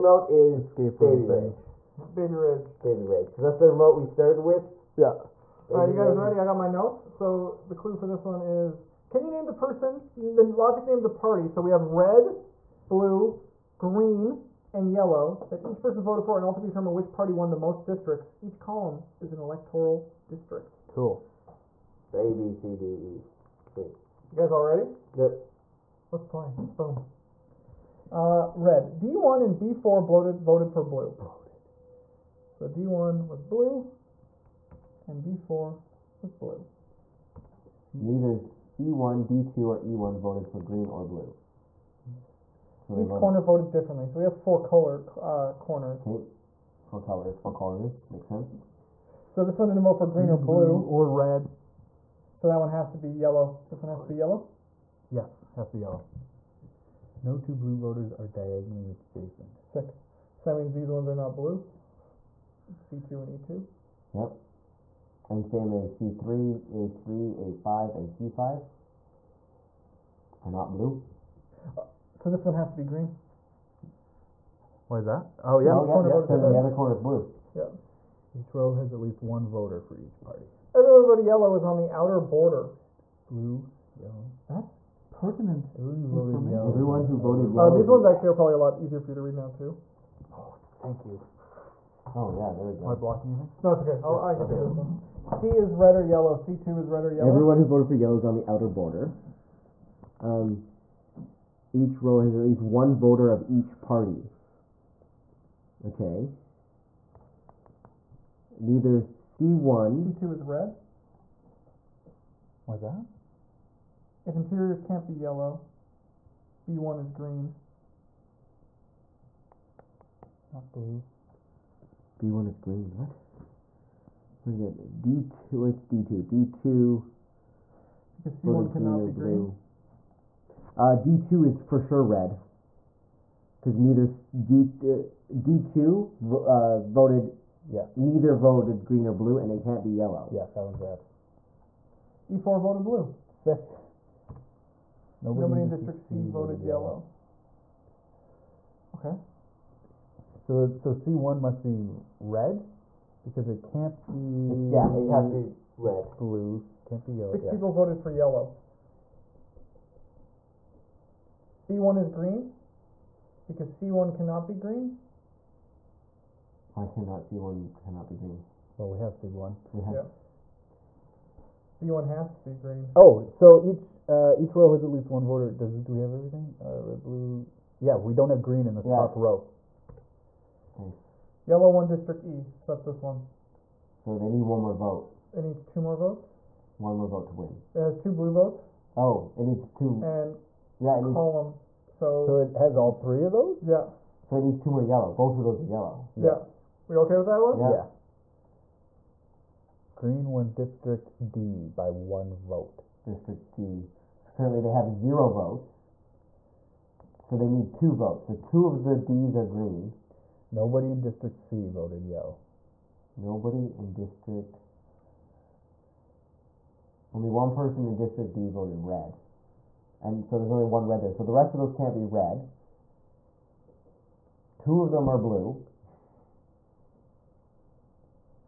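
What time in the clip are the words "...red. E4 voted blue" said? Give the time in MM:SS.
02:20.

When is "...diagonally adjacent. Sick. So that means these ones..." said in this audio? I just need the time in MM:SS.
00:58.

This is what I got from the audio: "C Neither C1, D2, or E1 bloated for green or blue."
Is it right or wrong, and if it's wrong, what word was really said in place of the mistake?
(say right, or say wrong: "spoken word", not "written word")
wrong: "voted", not "bloated".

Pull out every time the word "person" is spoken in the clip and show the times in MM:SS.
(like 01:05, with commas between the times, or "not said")
00:09, 00:15, 03:37.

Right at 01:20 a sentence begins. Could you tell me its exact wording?
Everyone but yellow is on the outer border.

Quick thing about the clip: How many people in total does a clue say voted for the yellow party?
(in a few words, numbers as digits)
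6.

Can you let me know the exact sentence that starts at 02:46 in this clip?
Why cannot C1 cannot be green?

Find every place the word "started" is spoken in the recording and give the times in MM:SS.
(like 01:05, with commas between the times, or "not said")
00:04.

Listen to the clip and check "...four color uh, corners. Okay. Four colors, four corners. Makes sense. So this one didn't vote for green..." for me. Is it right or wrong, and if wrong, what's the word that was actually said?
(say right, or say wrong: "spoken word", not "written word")
right.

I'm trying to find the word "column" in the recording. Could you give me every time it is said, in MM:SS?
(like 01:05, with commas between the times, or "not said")
00:18, 03:11.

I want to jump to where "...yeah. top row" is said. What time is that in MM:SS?
02:58.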